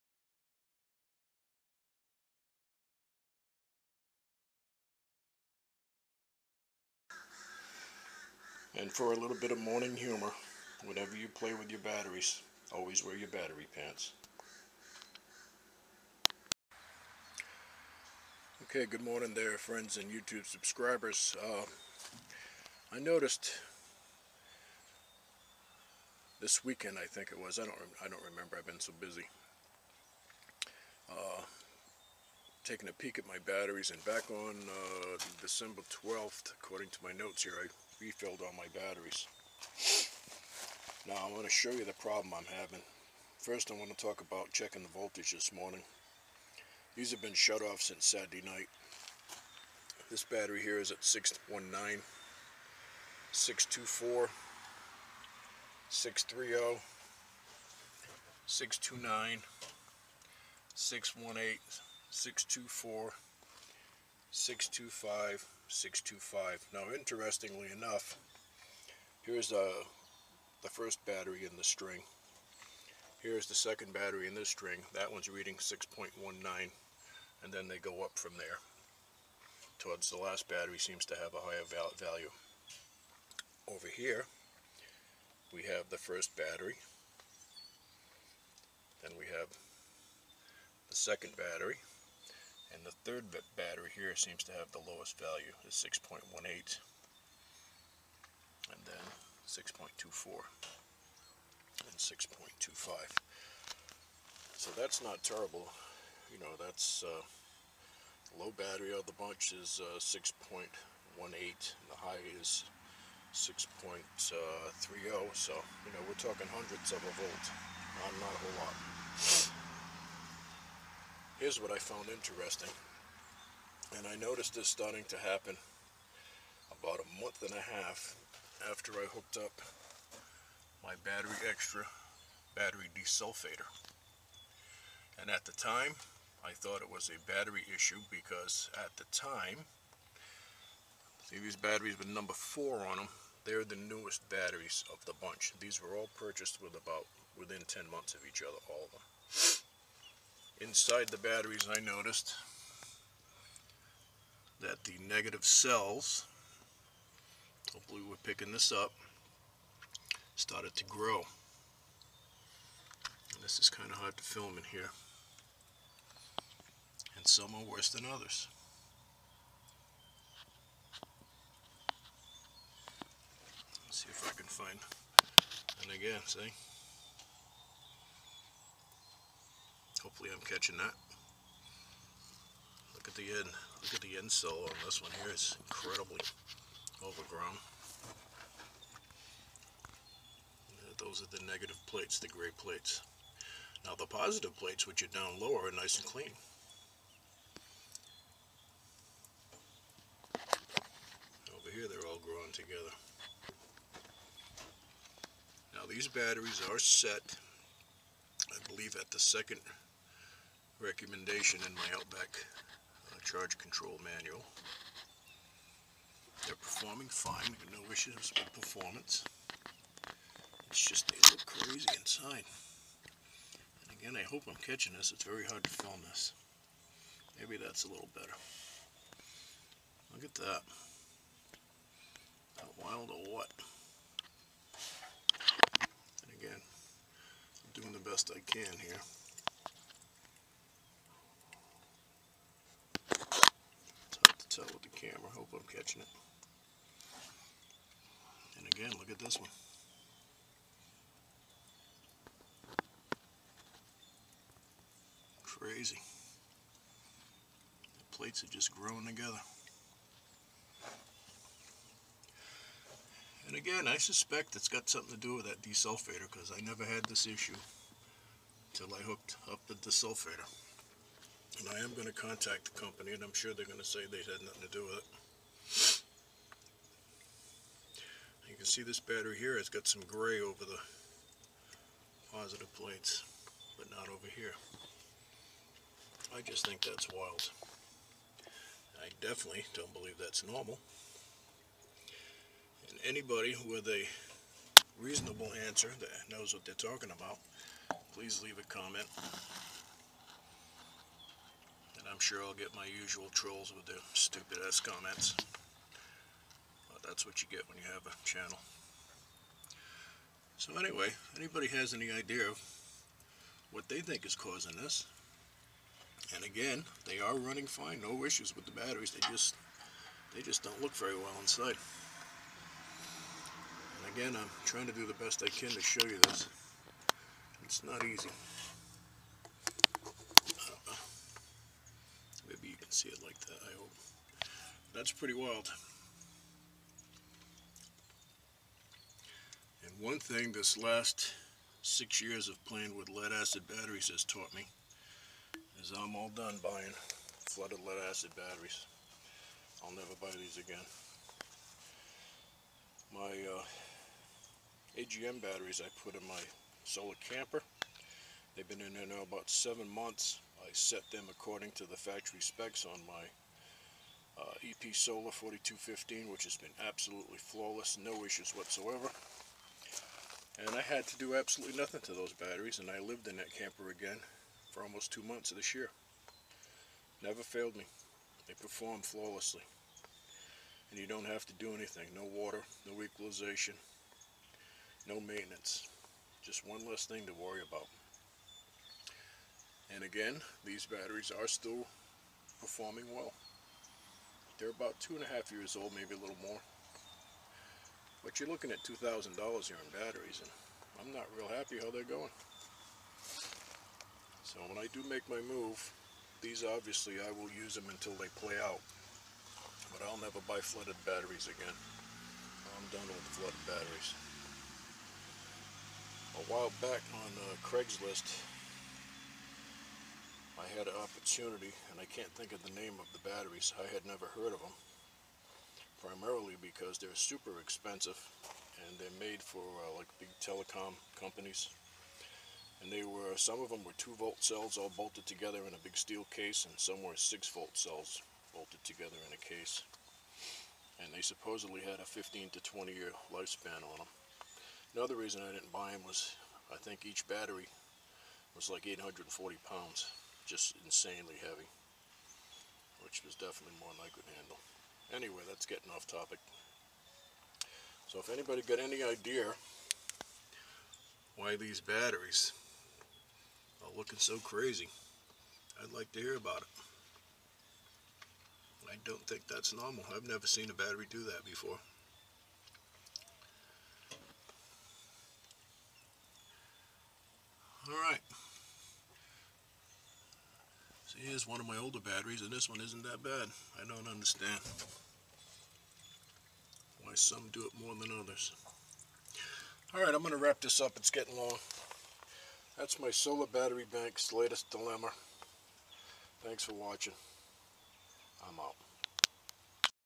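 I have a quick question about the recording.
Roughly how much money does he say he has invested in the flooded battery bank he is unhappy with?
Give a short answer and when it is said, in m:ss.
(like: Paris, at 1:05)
$2,000, at 6:38.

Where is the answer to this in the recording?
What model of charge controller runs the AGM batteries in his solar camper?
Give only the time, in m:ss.
6:04.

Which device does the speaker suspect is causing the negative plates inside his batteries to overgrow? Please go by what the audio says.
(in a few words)
battery desulfator.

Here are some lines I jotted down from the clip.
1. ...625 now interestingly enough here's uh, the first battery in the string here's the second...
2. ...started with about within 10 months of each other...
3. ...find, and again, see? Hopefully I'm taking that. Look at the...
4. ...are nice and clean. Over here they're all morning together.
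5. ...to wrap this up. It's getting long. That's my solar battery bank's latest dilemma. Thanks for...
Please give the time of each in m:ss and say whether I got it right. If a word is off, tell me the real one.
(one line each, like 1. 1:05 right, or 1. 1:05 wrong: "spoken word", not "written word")
1. 1:05 right
2. 2:26 wrong: "purchased", not "started"
3. 2:54 wrong: "catching", not "taking"
4. 3:15 wrong: "growing", not "morning"
5. 8:10 right.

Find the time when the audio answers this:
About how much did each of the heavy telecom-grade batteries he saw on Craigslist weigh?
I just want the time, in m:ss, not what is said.
7:28.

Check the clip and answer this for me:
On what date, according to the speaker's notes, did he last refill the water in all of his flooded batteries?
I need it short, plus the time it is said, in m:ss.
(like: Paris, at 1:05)
December 12th, at 0:35.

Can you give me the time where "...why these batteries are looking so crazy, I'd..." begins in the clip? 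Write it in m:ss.
7:41.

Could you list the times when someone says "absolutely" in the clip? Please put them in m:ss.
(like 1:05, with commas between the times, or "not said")
6:06, 6:11.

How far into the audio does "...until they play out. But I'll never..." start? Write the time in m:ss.
6:47.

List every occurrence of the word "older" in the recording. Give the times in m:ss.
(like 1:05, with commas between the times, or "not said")
8:01.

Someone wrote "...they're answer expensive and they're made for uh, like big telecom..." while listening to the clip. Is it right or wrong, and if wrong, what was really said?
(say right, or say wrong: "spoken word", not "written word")
wrong: "super", not "answer".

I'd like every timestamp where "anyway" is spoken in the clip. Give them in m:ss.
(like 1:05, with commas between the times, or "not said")
5:10, 7:35.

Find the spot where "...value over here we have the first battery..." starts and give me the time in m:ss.
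1:21.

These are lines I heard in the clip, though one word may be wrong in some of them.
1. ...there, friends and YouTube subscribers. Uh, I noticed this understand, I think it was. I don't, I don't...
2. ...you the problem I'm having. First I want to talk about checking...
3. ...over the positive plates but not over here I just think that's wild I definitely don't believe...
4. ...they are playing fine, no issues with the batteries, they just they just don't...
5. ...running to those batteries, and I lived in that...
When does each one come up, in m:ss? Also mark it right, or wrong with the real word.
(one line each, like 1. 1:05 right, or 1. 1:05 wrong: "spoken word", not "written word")
1. 0:19 wrong: "weekend", not "understand"
2. 0:41 right
3. 4:40 right
4. 5:17 wrong: "running", not "playing"
5. 6:11 wrong: "nothing", not "running".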